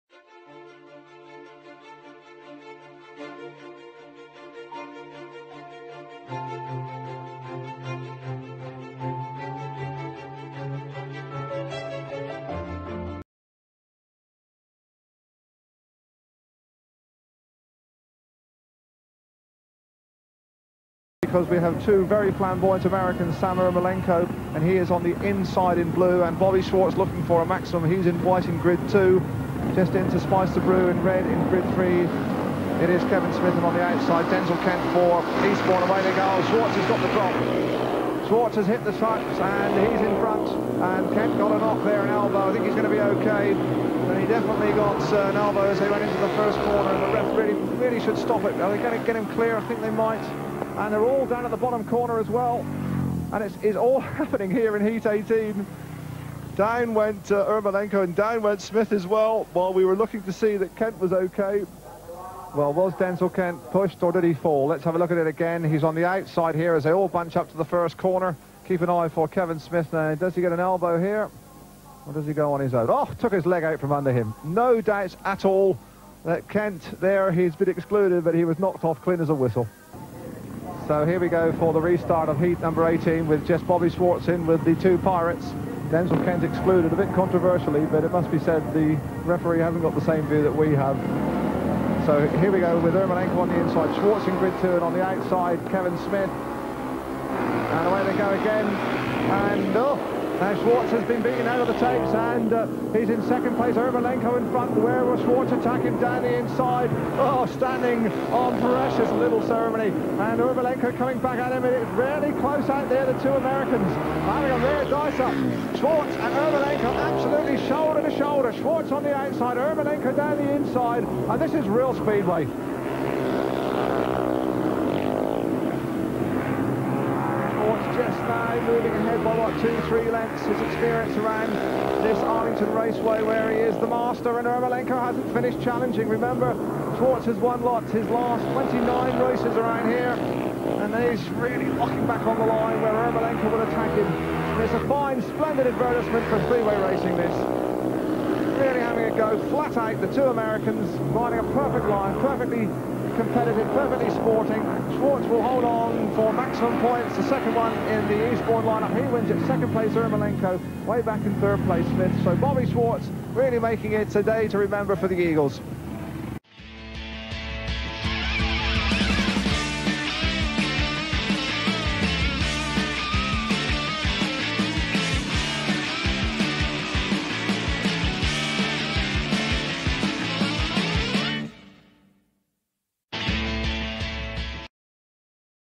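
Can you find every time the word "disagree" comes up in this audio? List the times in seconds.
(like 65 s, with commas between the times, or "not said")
not said.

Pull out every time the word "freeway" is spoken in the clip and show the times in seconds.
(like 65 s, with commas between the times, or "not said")
146 s.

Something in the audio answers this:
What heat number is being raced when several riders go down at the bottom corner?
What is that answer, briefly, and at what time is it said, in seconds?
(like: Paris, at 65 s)
18, at 54 s.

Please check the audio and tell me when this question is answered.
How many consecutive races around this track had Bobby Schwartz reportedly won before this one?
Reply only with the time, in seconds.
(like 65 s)
138 s.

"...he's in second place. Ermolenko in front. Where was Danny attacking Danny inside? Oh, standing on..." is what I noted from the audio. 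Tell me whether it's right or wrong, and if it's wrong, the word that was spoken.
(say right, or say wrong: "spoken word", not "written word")
wrong: "Schwartz", not "Danny".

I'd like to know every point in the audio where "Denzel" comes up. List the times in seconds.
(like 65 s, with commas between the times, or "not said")
34 s, 62 s, 85 s.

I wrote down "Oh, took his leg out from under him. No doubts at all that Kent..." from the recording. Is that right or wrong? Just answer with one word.
right.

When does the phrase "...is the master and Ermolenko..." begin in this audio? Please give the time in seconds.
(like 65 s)
133 s.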